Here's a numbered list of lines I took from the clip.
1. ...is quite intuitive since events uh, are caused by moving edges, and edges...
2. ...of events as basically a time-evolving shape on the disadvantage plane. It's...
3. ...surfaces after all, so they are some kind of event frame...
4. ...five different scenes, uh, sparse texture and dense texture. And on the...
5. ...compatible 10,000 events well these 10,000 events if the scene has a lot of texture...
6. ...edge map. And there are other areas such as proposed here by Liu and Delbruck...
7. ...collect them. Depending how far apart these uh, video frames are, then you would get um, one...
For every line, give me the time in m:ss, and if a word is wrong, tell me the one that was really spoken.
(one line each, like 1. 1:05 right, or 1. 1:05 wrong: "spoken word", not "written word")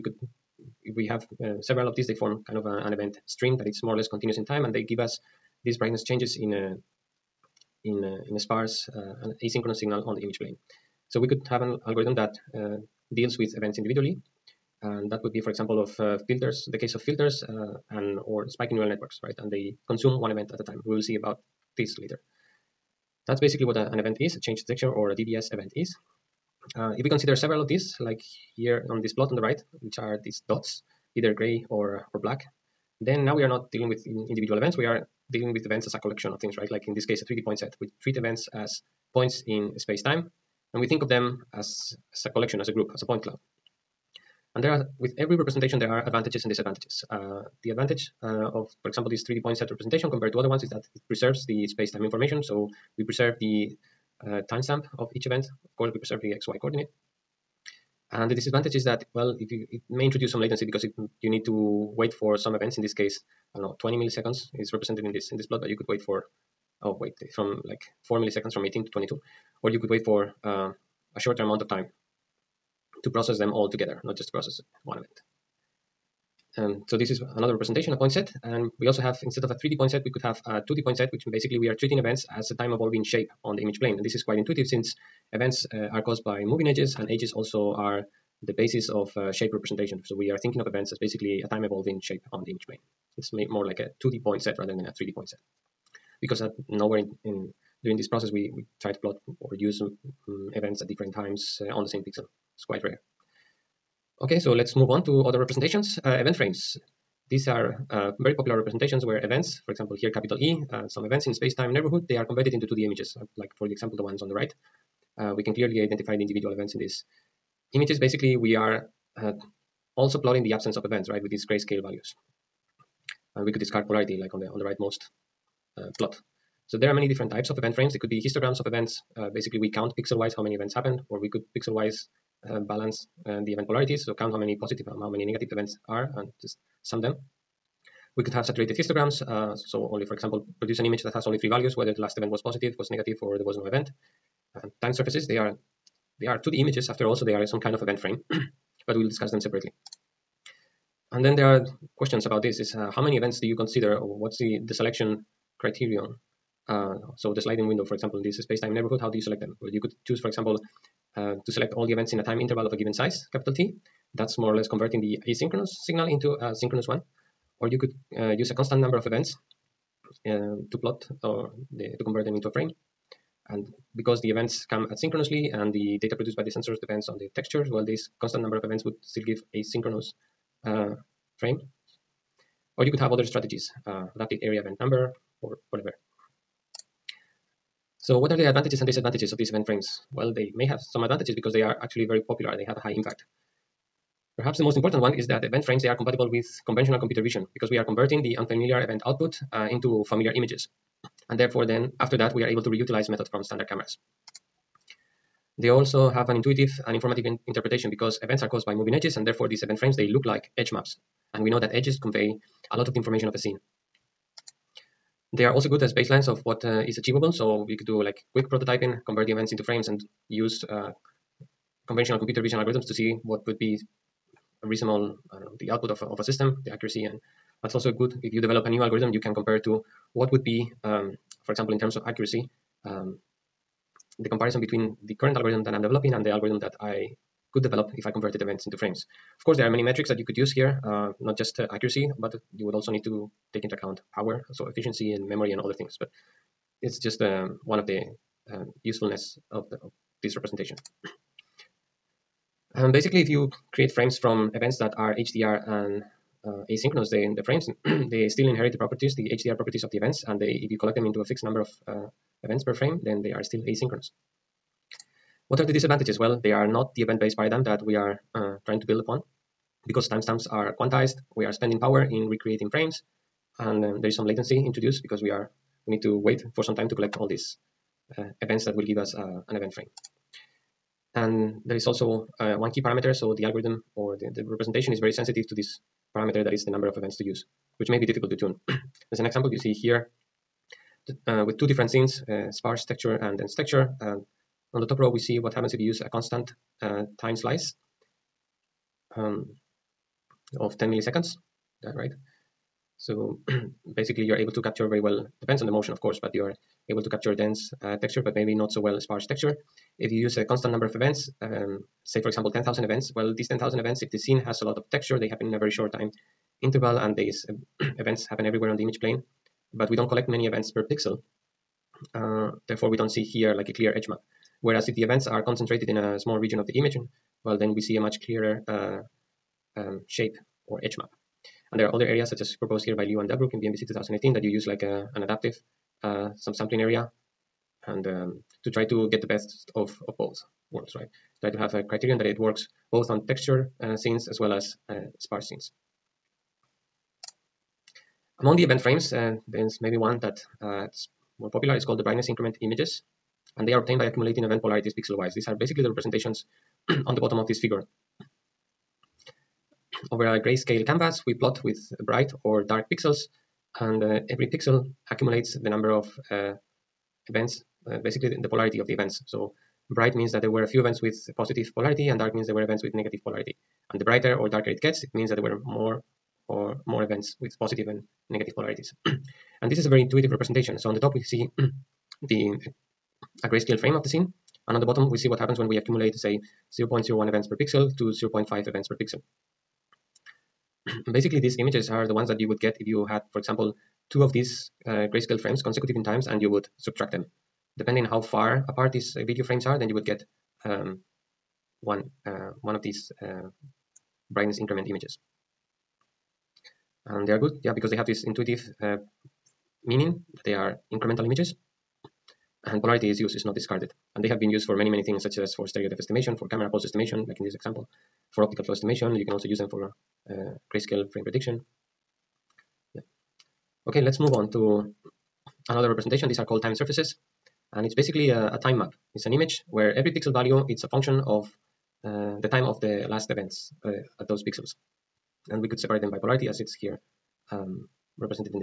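1. 1:24 right
2. 1:30 wrong: "image", not "disadvantage"
3. 2:26 wrong: "images", not "surfaces"
4. 4:51 wrong: "two", not "five"
5. 5:12 wrong: "example", not "compatible"
6. 5:30 right
7. 6:36 wrong: "subtract", not "collect".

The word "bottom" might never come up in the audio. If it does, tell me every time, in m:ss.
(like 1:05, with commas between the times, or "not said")
5:57, 6:24.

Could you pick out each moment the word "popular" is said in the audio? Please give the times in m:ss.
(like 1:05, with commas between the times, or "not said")
1:48, 3:12, 5:51.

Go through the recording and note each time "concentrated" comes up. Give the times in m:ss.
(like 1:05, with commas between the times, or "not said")
5:25.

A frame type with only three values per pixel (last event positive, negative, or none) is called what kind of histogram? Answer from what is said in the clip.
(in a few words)
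saturated histograms.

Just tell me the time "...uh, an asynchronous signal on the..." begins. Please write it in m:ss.
0:08.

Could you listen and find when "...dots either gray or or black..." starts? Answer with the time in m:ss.
0:30.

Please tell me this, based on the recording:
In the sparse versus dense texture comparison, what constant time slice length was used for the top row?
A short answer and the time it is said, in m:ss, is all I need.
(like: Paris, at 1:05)
10 milliseconds, at 5:00.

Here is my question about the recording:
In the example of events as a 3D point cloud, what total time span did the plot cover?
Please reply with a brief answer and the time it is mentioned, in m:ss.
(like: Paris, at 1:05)
20 milliseconds, at 1:03.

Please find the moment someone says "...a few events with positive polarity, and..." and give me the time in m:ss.
6:10.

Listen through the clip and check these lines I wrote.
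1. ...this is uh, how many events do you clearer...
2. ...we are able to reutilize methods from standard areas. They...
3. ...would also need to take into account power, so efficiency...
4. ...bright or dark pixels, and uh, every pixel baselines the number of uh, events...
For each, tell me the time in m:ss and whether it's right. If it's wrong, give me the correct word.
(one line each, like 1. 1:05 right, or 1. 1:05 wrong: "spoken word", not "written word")
1. 2:32 wrong: "consider", not "clearer"
2. 3:22 wrong: "cameras", not "areas"
3. 4:02 right
4. 6:02 wrong: "accumulates", not "baselines".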